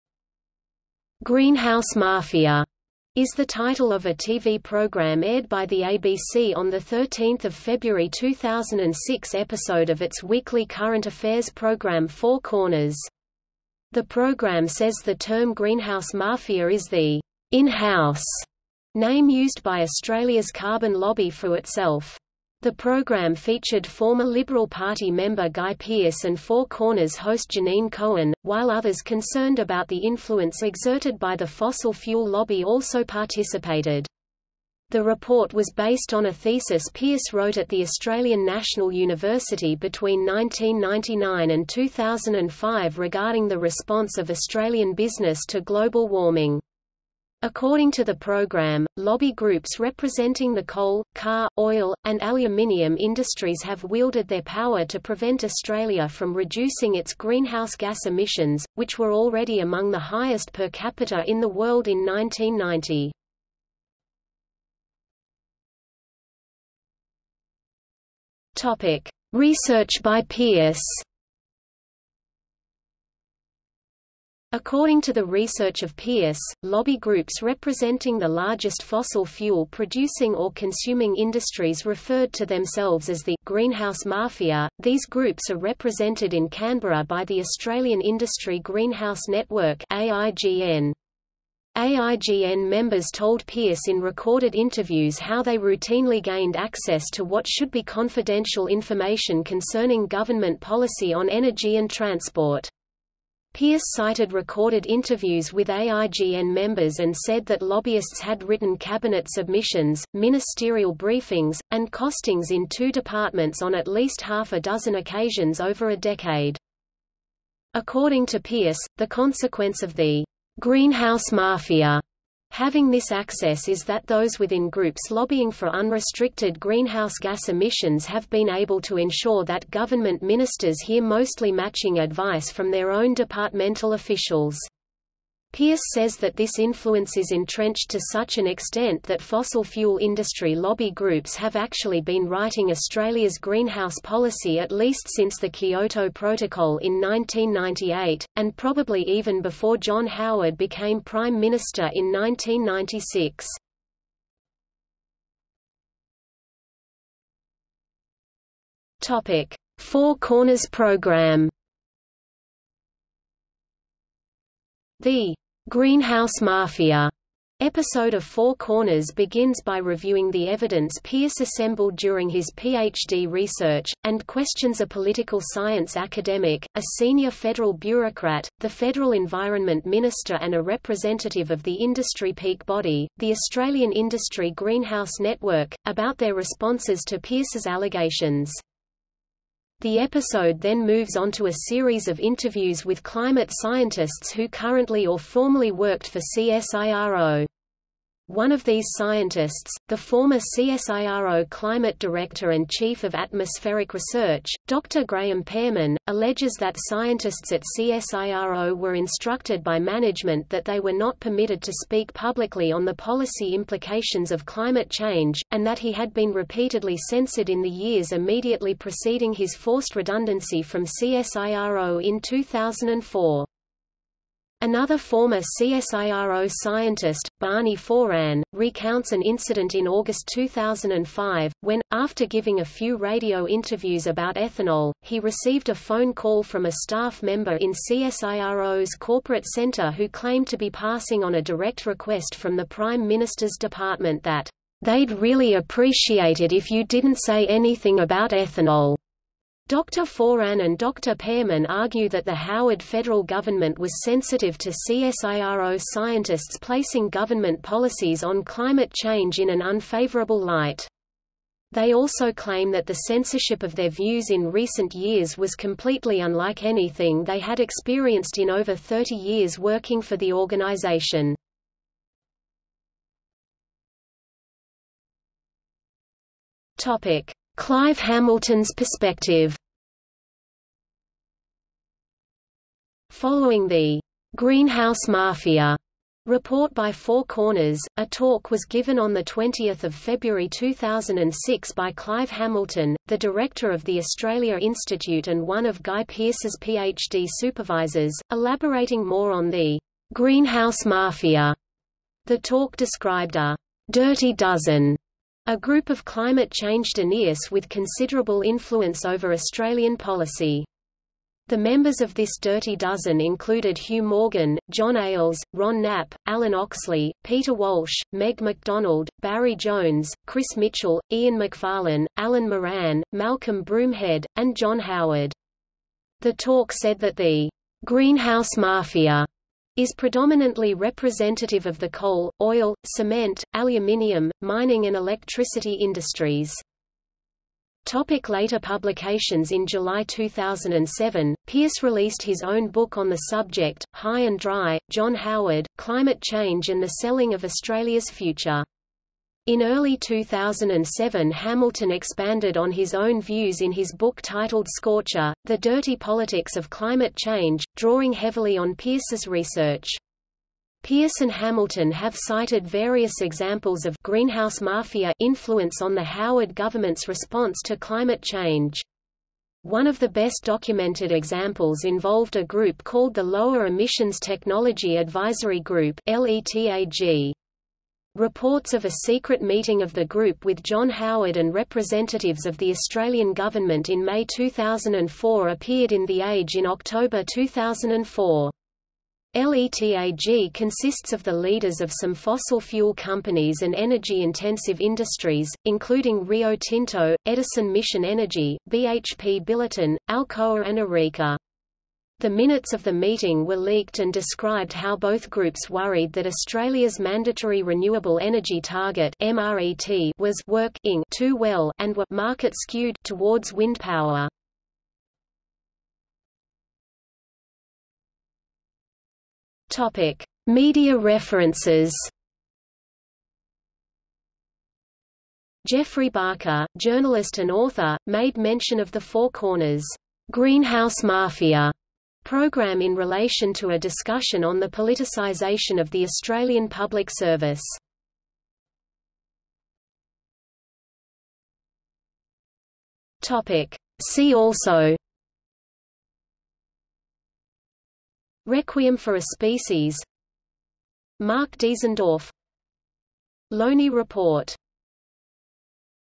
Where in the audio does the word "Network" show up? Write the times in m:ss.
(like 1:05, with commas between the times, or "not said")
1:29, 3:05.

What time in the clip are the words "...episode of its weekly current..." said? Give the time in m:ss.
0:09.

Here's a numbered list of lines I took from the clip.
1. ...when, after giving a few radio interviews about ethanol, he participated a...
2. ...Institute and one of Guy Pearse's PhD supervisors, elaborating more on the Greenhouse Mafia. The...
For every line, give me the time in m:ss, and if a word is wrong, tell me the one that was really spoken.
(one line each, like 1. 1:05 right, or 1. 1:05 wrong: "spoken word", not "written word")
1. 3:51 wrong: "received", not "participated"
2. 4:54 right.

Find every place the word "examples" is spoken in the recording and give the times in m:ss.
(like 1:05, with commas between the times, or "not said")
6:03, 6:11.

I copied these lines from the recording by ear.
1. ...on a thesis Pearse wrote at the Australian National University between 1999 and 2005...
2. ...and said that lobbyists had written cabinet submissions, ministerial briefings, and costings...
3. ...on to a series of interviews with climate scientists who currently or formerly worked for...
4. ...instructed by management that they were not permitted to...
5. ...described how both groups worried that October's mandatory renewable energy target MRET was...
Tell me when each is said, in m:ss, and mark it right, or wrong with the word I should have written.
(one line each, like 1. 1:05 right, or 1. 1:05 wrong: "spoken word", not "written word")
1. 0:36 right
2. 1:46 right
3. 3:11 right
4. 3:28 right
5. 6:44 wrong: "Australia", not "October".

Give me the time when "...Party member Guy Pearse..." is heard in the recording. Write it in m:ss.
0:24.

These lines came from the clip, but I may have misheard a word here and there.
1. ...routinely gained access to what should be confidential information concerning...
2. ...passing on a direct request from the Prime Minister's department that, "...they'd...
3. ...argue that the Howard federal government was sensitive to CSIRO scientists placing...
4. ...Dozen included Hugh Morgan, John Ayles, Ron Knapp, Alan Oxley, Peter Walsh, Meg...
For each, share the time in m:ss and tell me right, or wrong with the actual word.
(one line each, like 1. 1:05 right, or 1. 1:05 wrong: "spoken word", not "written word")
1. 1:35 right
2. 4:00 right
3. 4:11 right
4. 5:12 right.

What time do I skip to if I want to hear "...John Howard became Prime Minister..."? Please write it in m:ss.
2:29.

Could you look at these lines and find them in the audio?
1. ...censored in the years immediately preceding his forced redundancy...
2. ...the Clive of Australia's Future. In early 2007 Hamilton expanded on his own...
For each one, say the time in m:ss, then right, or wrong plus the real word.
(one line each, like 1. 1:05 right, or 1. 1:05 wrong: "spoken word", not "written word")
1. 3:37 right
2. 5:46 wrong: "Selling", not "Clive".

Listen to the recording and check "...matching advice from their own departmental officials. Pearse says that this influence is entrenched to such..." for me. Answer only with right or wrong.
right.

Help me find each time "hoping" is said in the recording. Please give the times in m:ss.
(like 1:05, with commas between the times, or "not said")
not said.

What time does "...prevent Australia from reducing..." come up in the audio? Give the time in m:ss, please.
0:54.